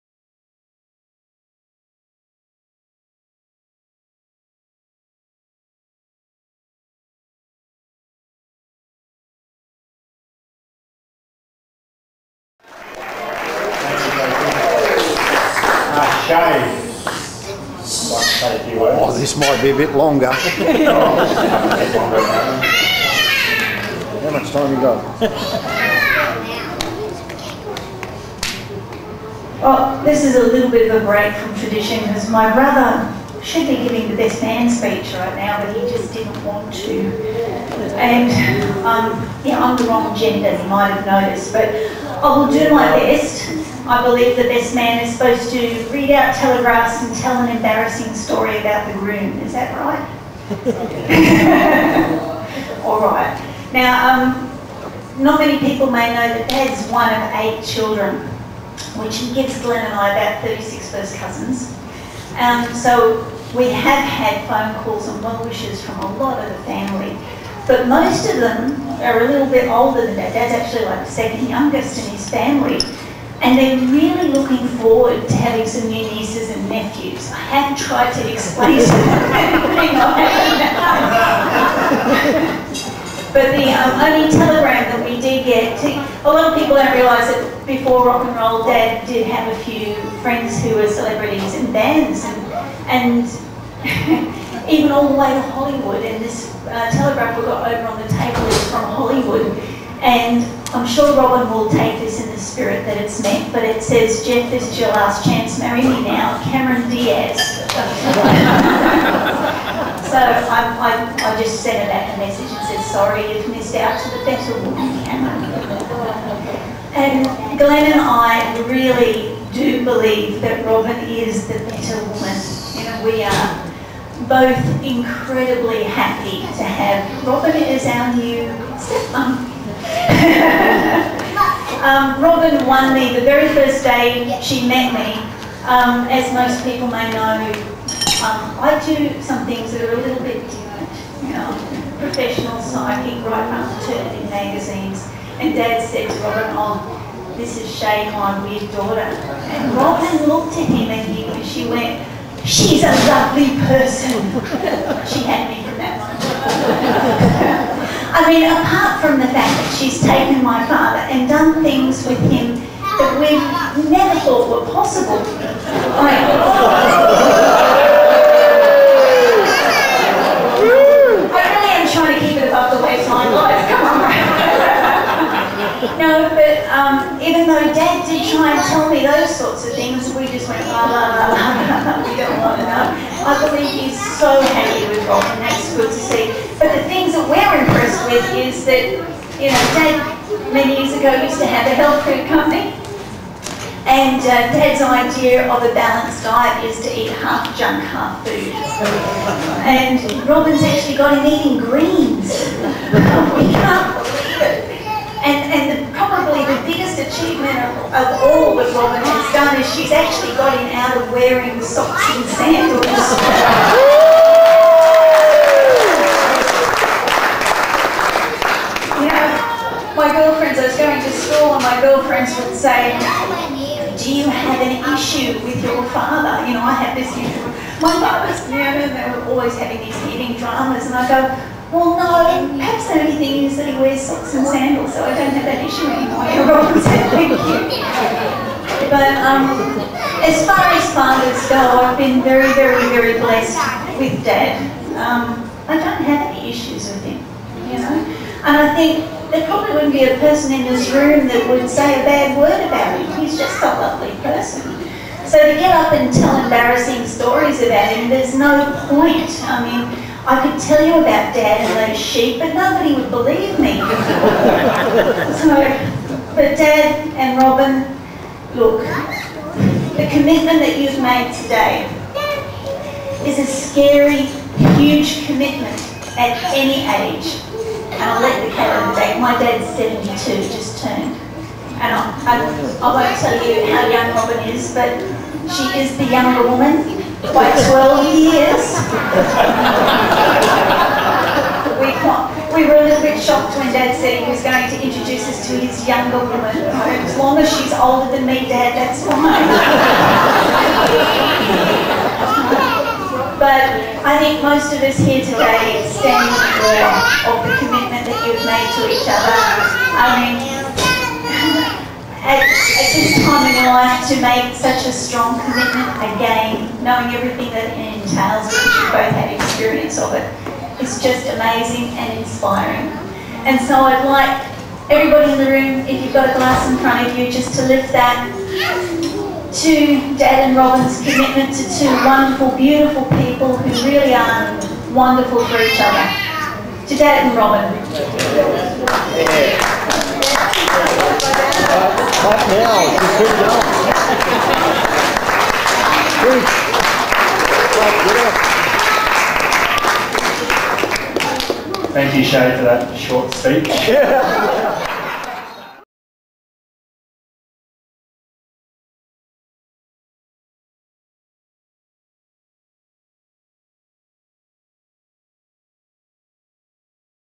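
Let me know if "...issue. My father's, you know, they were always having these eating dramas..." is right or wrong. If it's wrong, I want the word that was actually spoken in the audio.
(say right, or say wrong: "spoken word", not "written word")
right.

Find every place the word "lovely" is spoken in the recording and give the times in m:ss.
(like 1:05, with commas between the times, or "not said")
2:33, 4:13.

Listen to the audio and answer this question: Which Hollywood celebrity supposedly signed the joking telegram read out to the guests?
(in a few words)
Cameron Diaz.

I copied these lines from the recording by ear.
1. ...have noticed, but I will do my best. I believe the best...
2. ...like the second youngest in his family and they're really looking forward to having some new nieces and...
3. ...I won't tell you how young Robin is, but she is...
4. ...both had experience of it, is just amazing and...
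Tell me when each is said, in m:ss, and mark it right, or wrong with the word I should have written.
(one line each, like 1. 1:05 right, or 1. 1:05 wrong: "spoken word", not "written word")
1. 0:40 right
2. 1:10 right
3. 4:42 right
4. 5:18 right.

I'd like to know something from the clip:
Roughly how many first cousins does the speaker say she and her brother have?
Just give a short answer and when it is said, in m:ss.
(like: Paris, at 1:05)
36, at 1:00.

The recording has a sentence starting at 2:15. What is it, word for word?
Um, as most people may know, um, I do some things that are a little bit different.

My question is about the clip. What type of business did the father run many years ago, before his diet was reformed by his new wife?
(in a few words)
Health food company.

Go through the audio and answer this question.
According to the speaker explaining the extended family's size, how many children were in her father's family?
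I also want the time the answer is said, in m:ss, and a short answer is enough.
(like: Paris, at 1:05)
8, at 0:57.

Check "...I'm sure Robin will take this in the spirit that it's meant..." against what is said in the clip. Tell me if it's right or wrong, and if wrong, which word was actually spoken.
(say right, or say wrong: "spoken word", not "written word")
right.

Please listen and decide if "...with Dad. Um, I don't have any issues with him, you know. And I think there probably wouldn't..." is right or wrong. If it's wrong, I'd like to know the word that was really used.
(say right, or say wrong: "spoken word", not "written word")
right.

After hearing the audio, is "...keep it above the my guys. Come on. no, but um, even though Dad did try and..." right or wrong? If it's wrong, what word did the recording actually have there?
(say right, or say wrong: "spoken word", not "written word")
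right.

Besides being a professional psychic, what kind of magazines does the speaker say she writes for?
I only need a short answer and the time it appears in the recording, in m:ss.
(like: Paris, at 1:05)
Maternity magazines, at 2:23.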